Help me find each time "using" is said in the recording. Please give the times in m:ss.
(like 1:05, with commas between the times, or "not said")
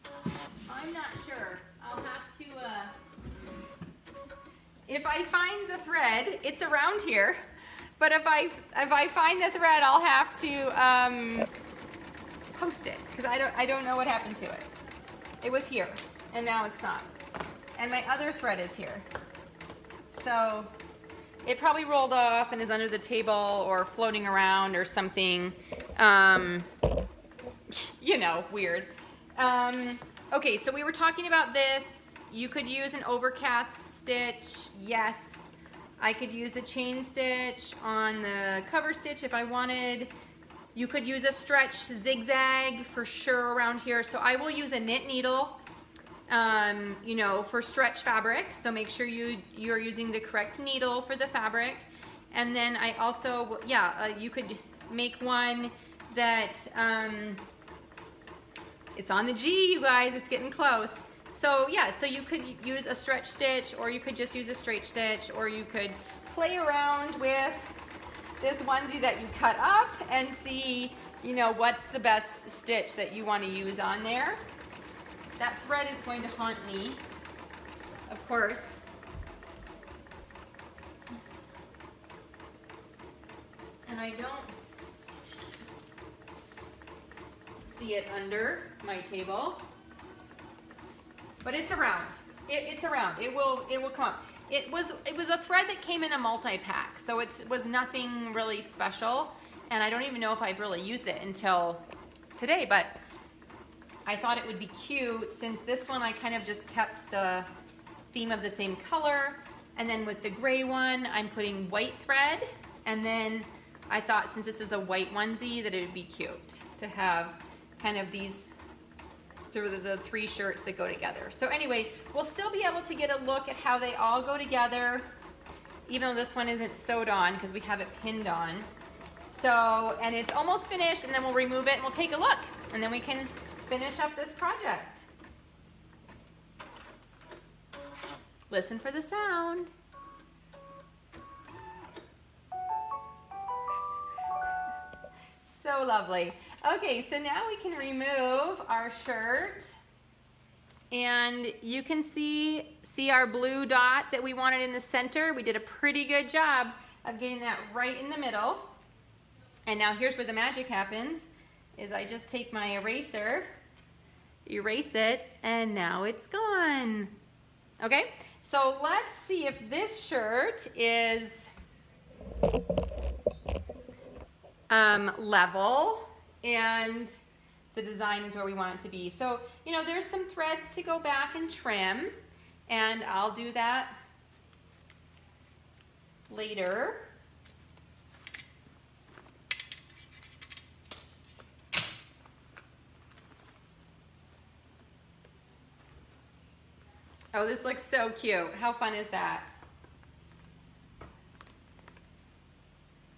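0:49.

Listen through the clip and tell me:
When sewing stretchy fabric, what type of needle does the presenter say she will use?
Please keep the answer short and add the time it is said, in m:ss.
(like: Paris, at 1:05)
Knit needle, at 0:44.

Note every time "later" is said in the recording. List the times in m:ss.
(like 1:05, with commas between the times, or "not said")
3:06.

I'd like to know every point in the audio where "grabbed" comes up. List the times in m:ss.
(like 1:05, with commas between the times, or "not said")
not said.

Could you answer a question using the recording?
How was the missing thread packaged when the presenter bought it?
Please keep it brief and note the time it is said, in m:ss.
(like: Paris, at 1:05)
In a multi-pack, at 1:36.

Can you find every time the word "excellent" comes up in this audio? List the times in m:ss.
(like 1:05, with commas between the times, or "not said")
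not said.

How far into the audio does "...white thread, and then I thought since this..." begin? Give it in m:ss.
1:51.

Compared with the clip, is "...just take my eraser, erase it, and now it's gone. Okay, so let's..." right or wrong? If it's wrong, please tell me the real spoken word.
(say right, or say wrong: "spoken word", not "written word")
right.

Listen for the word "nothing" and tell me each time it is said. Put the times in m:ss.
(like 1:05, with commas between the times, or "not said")
1:37.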